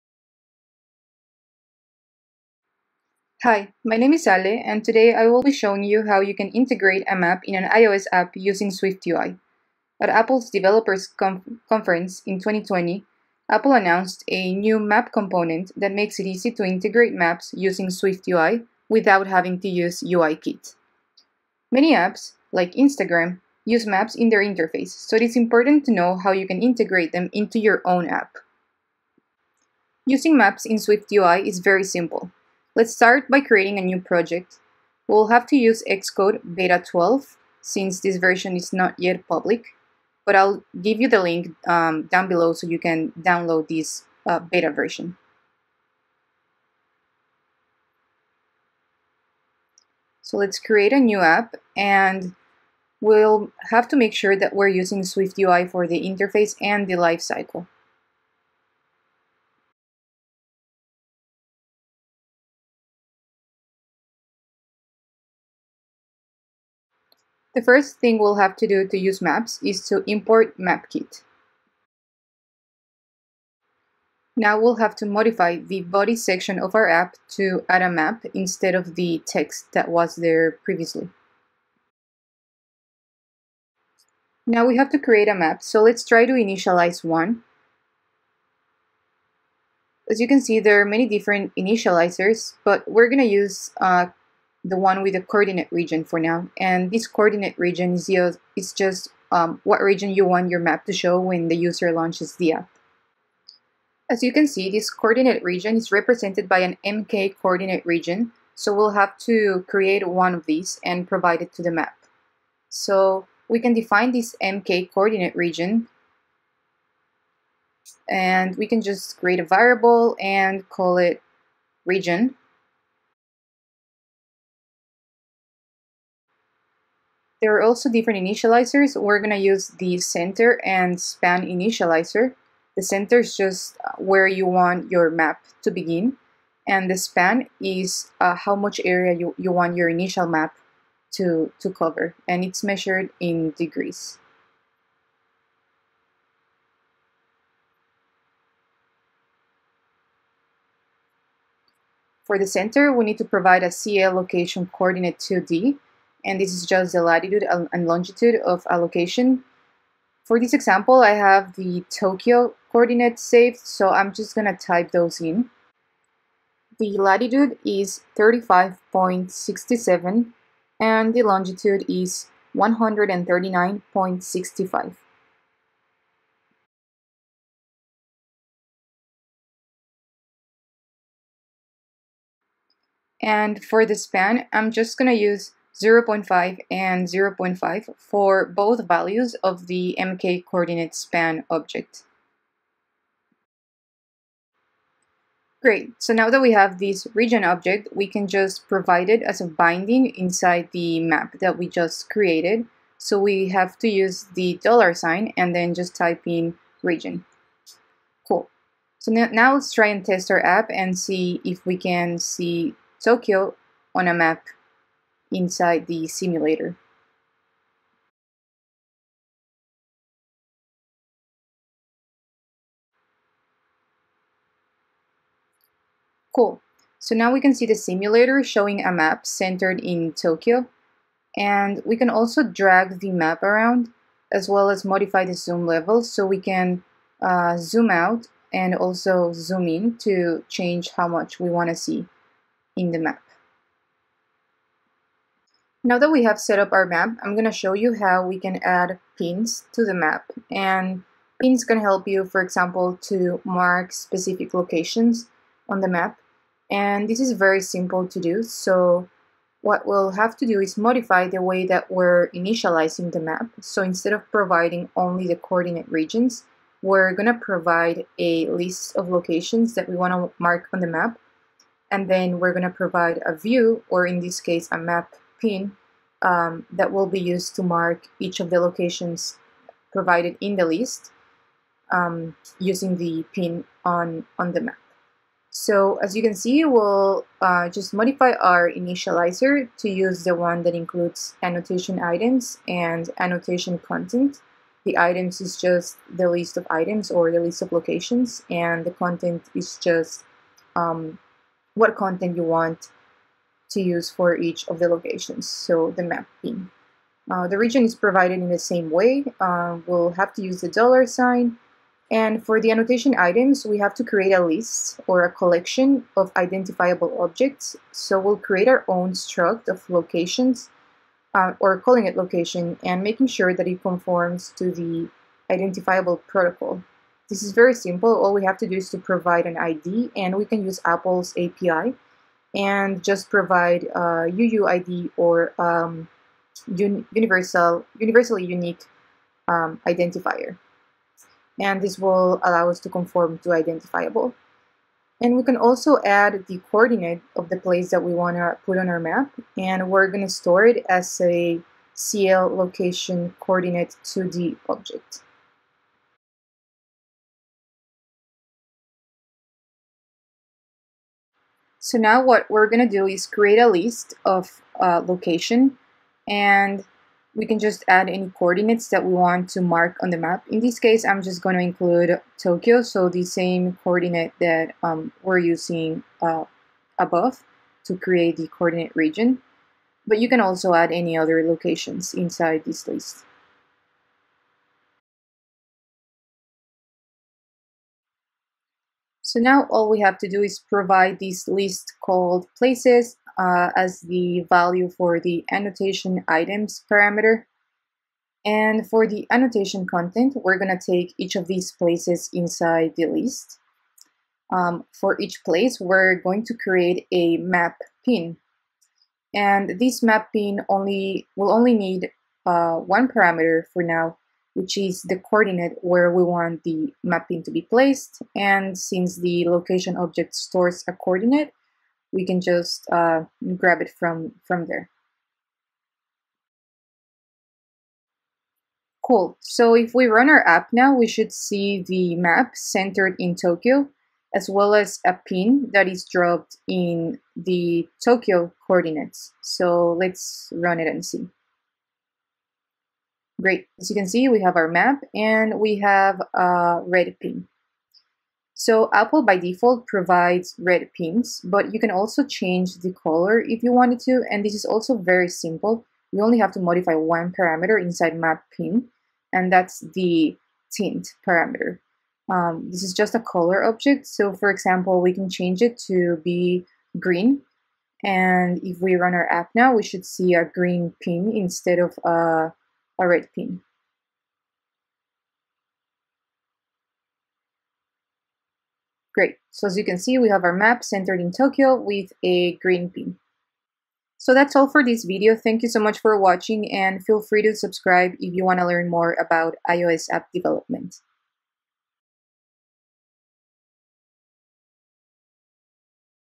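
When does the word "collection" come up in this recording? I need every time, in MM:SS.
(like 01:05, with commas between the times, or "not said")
05:15.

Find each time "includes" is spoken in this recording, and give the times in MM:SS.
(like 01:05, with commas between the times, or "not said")
04:50, 06:11.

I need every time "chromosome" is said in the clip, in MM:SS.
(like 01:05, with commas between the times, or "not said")
not said.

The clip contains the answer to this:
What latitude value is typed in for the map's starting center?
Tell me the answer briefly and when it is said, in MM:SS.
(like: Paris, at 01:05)
35.67, at 02:48.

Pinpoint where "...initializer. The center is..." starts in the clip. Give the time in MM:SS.
02:11.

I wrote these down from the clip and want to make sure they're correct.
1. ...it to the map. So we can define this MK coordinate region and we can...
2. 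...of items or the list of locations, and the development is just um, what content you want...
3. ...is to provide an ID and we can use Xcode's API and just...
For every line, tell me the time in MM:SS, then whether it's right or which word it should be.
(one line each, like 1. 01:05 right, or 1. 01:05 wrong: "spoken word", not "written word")
1. 01:51 right
2. 04:56 wrong: "content", not "development"
3. 05:28 wrong: "Apple", not "Xcode".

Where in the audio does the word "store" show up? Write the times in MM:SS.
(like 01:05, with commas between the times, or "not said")
05:50, 07:00.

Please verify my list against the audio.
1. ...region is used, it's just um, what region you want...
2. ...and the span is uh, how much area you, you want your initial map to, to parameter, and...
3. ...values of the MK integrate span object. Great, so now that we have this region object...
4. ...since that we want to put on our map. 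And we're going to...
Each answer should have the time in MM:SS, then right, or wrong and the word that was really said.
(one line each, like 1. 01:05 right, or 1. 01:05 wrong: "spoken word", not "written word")
1. 01:37 right
2. 02:16 wrong: "cover", not "parameter"
3. 03:08 wrong: "coordinate", not "integrate"
4. 05:47 wrong: "place", not "since".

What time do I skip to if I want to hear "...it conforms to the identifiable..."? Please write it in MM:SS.
05:23.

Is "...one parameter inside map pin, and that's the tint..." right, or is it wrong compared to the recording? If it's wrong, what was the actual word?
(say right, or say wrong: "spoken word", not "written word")
right.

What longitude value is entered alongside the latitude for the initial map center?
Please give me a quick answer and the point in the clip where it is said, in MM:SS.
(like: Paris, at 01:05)
139.65, at 02:52.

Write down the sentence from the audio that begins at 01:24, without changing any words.
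Now we have to create a map, so let's try to initialize one.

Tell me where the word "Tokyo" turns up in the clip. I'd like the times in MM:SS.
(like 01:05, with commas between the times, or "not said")
02:41, 03:33, 03:50, 06:12, 07:13, 07:18, 08:01.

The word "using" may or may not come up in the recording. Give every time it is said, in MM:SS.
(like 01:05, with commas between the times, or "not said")
00:08, 00:17, 00:30, 00:54, 04:42, 06:15.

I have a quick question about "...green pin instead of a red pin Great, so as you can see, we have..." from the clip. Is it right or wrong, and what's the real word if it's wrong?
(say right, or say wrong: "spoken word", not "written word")
right.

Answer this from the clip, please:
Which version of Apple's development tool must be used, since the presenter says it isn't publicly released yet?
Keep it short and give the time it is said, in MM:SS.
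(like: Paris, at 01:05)
Xcode Beta 12, at 00:35.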